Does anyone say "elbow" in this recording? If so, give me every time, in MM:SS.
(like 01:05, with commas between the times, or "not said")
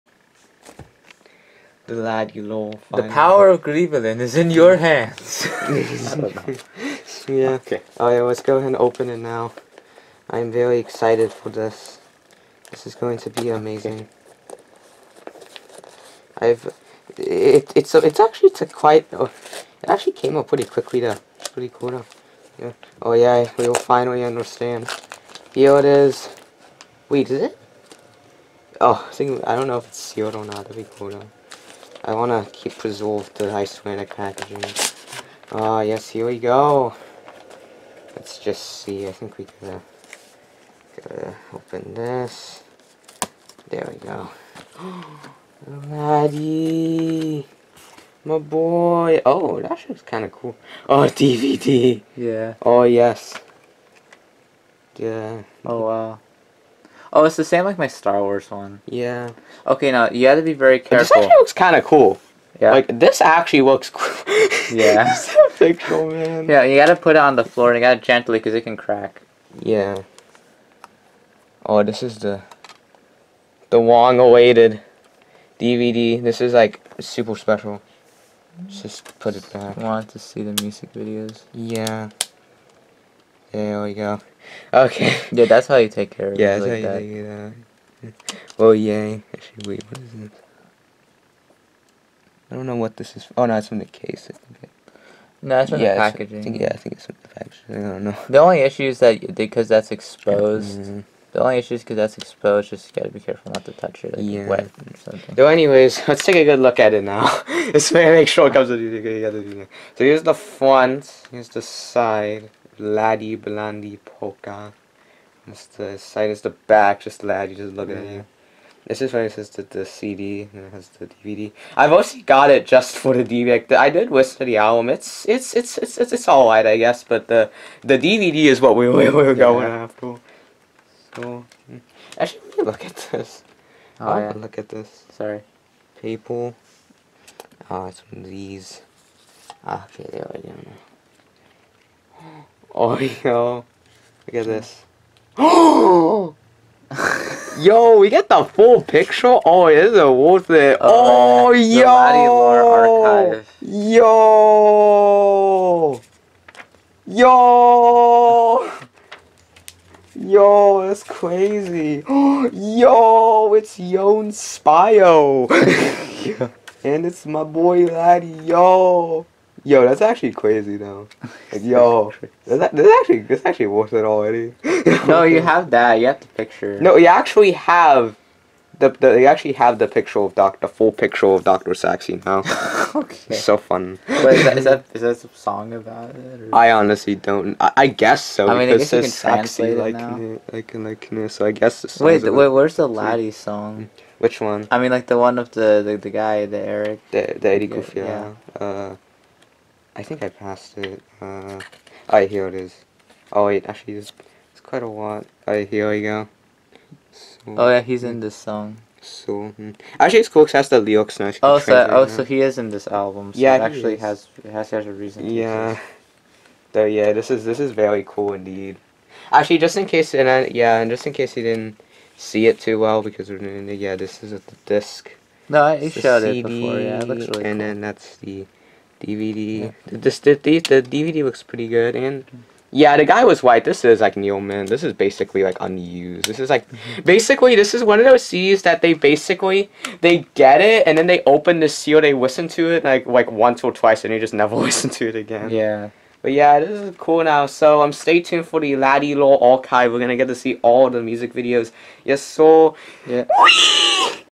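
not said.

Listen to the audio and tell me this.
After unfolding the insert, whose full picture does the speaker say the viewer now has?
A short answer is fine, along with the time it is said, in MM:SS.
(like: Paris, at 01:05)
Doctor Saxy, at 03:01.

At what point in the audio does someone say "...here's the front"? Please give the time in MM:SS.
01:50.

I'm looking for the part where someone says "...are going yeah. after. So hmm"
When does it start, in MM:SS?
02:09.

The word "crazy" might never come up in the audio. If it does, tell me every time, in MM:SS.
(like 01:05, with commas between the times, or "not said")
02:41, 02:50.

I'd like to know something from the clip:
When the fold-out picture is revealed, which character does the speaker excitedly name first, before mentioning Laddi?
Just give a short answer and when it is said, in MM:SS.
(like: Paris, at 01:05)
Jón Spæjó, at 02:43.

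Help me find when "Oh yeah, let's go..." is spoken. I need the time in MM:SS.
00:07.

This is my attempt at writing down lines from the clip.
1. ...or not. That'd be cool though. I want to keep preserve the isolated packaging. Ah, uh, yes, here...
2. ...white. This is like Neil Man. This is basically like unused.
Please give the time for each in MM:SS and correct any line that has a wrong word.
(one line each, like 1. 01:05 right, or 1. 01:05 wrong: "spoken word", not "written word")
1. 00:30 right
2. 03:53 right.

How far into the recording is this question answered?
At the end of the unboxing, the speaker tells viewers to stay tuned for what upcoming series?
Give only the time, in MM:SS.
04:08.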